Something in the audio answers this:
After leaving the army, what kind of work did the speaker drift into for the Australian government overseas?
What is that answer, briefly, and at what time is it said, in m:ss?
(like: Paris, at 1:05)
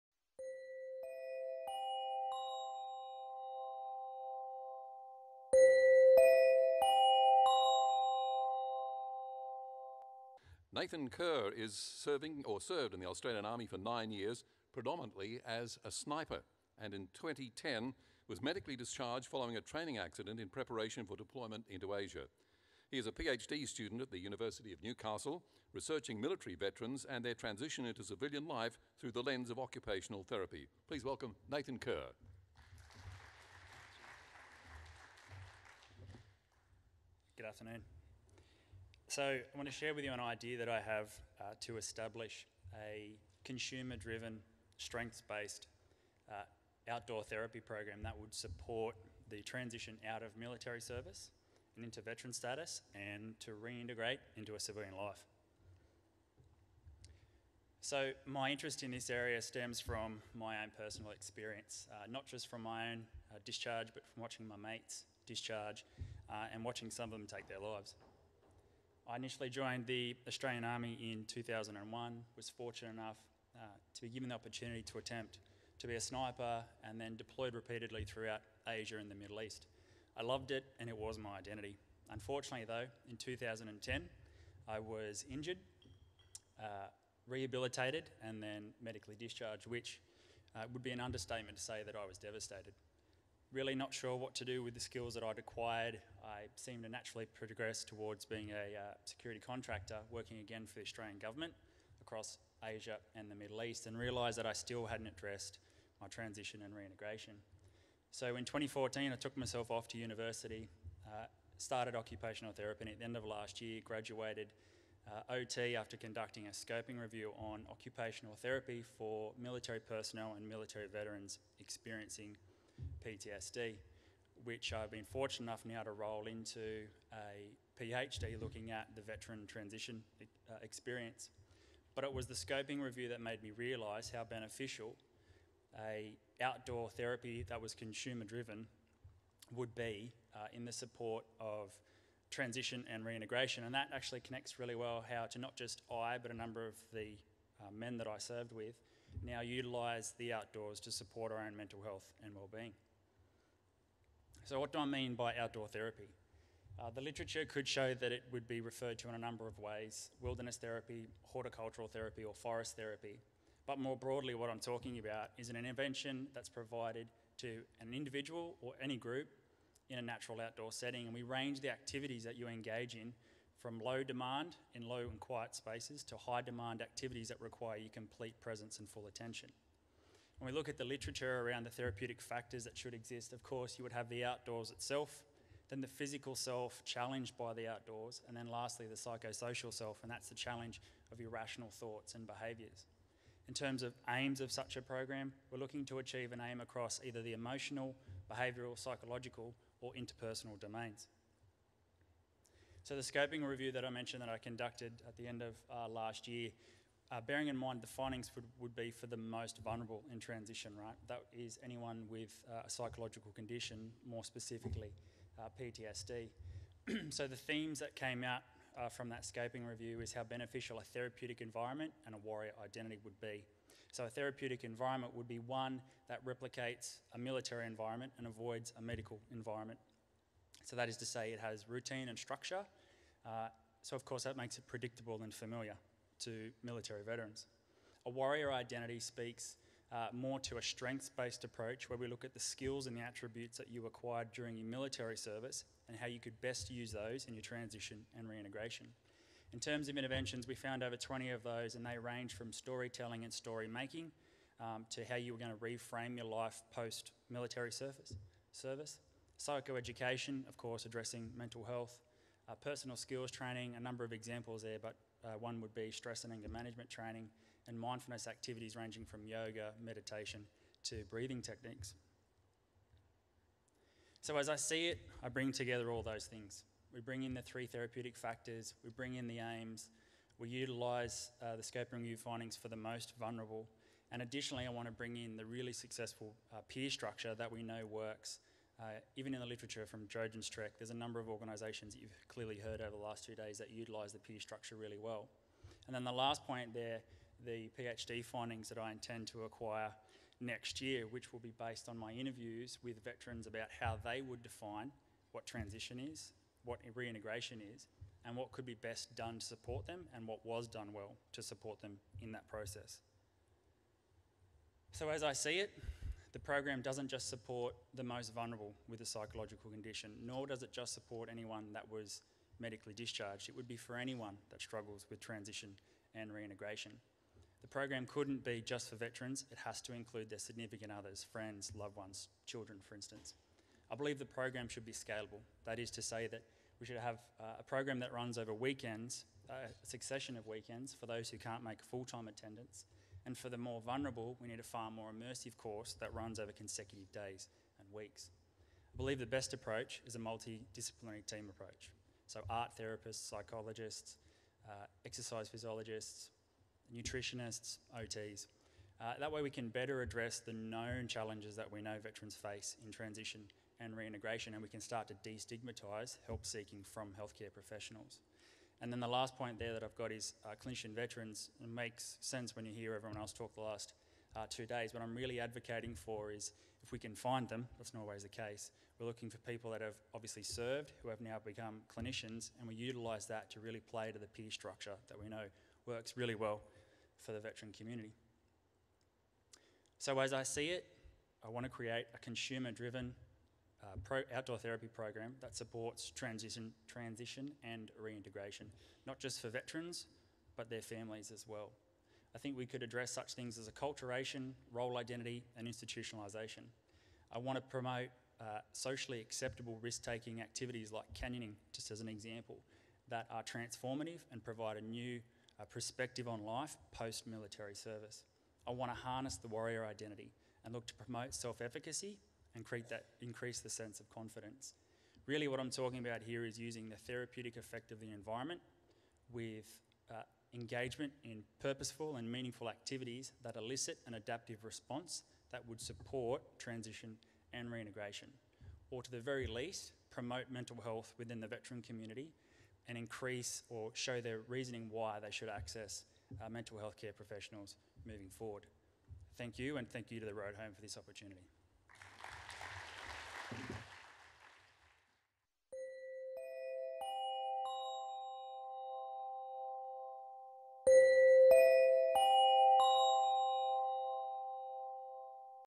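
Security contractor, at 1:39.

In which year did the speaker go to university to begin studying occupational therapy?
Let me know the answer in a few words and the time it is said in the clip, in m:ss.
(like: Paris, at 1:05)
2014, at 1:48.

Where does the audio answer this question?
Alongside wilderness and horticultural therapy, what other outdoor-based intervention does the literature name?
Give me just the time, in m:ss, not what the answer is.
2:42.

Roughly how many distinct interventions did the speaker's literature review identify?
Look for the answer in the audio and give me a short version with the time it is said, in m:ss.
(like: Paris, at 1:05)
Over 20, at 4:10.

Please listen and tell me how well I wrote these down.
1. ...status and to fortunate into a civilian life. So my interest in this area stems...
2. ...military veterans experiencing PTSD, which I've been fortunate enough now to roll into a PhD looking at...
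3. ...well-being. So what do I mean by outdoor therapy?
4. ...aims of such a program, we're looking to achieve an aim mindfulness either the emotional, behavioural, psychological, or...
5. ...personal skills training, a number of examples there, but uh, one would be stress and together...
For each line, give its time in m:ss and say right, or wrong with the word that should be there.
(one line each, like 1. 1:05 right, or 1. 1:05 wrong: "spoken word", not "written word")
1. 0:52 wrong: "reintegrate", not "fortunate"
2. 2:00 right
3. 2:32 right
4. 3:14 wrong: "across", not "mindfulness"
5. 4:22 wrong: "anger", not "together".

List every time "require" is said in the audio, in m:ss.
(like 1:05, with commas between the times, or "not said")
2:57.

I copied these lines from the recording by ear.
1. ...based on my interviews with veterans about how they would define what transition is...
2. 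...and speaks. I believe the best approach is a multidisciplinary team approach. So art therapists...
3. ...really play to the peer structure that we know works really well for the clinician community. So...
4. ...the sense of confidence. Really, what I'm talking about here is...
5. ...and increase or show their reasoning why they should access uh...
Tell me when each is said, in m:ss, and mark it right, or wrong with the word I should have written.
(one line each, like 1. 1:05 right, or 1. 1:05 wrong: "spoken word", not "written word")
1. 5:01 right
2. 5:47 wrong: "weeks", not "speaks"
3. 6:23 wrong: "veteran", not "clinician"
4. 7:03 right
5. 7:22 right.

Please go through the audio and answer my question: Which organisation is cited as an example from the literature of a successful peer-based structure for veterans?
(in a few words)
Trojan's Trek.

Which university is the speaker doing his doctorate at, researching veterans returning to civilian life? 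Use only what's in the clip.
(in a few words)
University of Newcastle.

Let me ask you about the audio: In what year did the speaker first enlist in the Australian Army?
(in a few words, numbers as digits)
2001.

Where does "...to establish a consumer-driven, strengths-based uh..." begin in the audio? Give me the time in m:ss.
0:41.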